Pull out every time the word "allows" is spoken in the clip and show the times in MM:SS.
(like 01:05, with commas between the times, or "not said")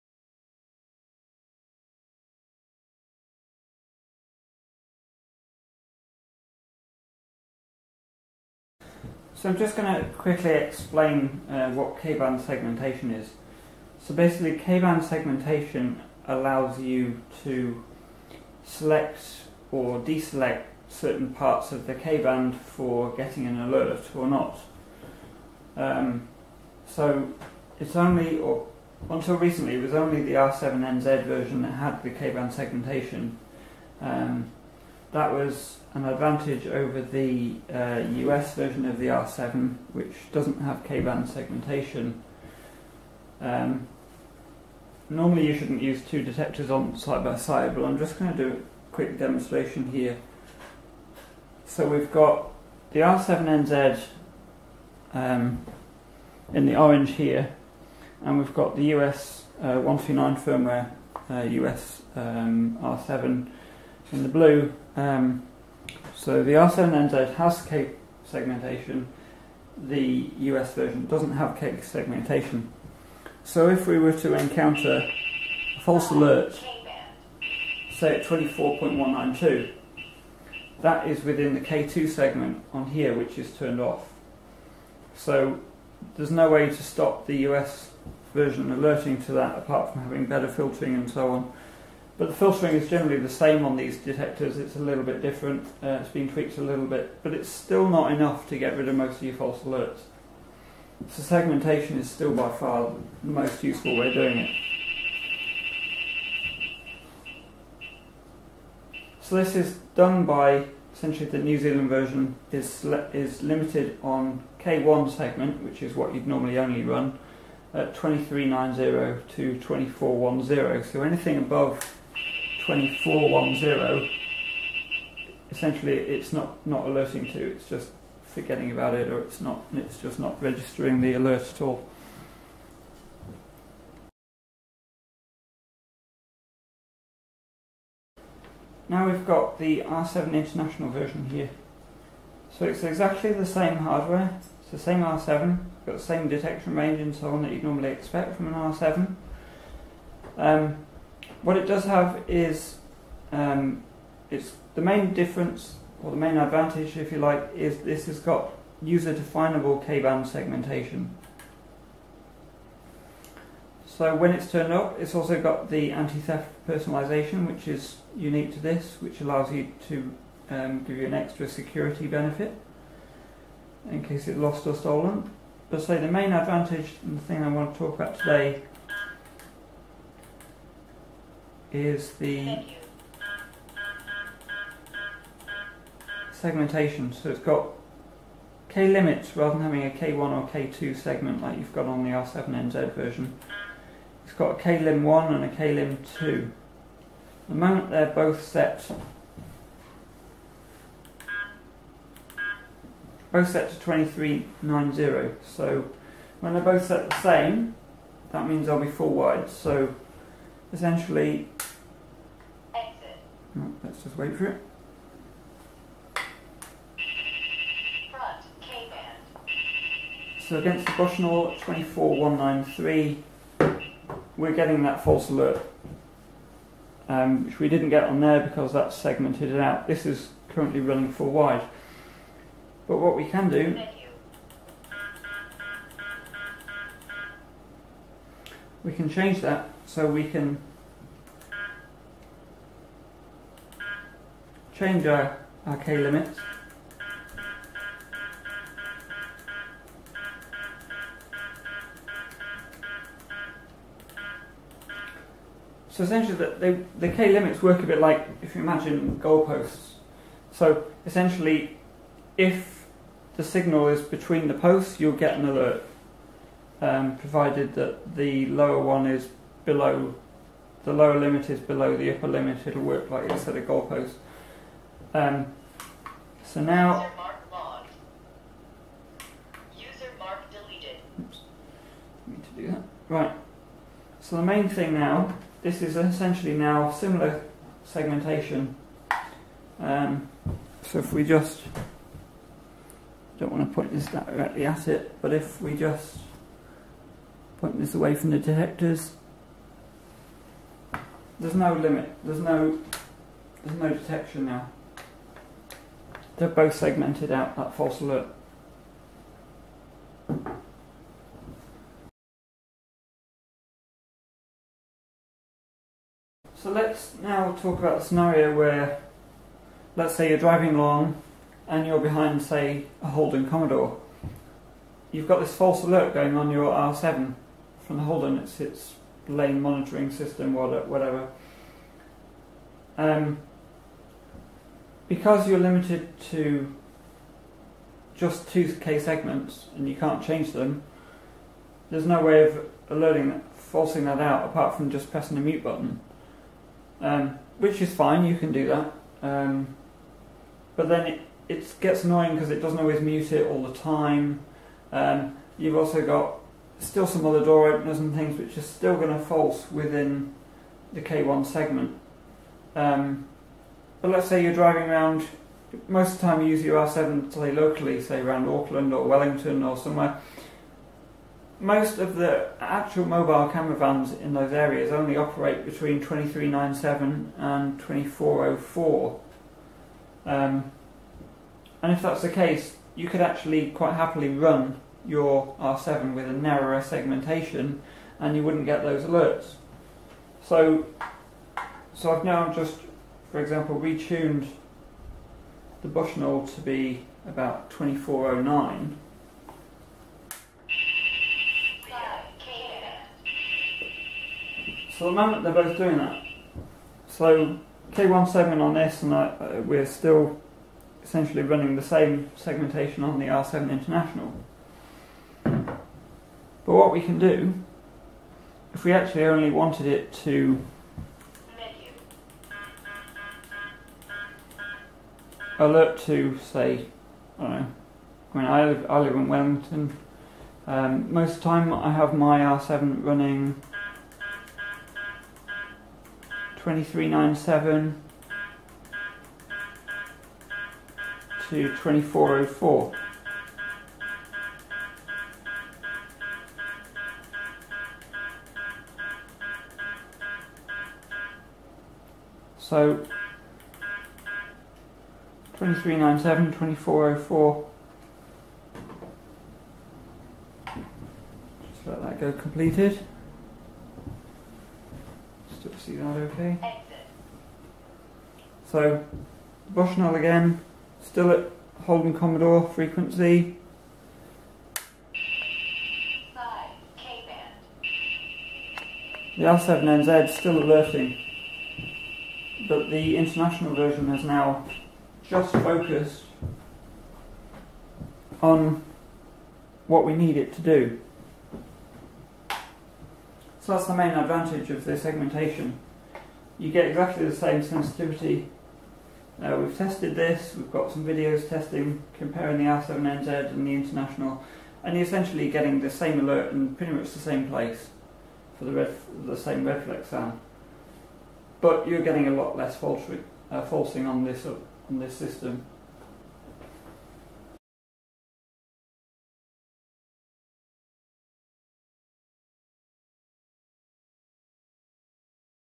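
00:16, 02:49.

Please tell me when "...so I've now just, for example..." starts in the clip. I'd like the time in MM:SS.
06:31.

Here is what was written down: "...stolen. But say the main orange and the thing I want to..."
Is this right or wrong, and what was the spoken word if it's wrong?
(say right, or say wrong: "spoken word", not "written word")
wrong: "advantage", not "orange".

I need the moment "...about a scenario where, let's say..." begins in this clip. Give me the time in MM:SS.
05:17.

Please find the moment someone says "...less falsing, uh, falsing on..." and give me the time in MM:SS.
08:32.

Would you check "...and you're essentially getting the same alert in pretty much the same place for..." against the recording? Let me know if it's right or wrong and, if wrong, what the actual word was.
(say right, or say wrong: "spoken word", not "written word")
right.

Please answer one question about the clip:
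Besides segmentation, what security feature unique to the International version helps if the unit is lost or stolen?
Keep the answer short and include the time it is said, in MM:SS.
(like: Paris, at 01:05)
Anti-theft personalization, at 02:45.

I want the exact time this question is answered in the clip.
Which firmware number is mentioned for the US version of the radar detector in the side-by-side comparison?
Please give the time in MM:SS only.
00:59.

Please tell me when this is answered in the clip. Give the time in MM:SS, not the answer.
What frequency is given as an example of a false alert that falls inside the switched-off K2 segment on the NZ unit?
01:18.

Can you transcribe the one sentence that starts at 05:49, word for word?
Um, but then it, it gets annoying because it doesn't always mute it all the time.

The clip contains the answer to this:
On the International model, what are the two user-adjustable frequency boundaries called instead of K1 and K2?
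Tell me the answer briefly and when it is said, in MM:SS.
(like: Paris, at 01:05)
KLIM1 and KLIM2, at 03:14.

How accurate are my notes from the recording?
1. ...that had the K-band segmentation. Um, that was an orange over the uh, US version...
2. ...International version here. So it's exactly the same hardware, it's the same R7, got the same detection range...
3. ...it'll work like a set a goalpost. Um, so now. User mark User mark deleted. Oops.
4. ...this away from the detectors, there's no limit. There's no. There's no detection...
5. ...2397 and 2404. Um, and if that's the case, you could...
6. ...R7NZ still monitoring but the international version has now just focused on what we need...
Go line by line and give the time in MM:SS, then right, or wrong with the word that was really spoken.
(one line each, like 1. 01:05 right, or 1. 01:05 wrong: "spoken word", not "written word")
1. 00:31 wrong: "advantage", not "orange"
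2. 02:20 right
3. 04:32 right
4. 04:57 right
5. 06:15 right
6. 07:59 wrong: "alerting", not "monitoring".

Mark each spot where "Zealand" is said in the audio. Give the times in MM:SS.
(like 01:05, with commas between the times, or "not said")
01:51.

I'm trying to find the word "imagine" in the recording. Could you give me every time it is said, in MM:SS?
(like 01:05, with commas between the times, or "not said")
04:18.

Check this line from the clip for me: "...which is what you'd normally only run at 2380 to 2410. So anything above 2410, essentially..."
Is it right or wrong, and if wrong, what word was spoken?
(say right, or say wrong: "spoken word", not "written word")
wrong: "2390", not "2380".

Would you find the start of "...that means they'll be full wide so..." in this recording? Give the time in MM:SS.
03:28.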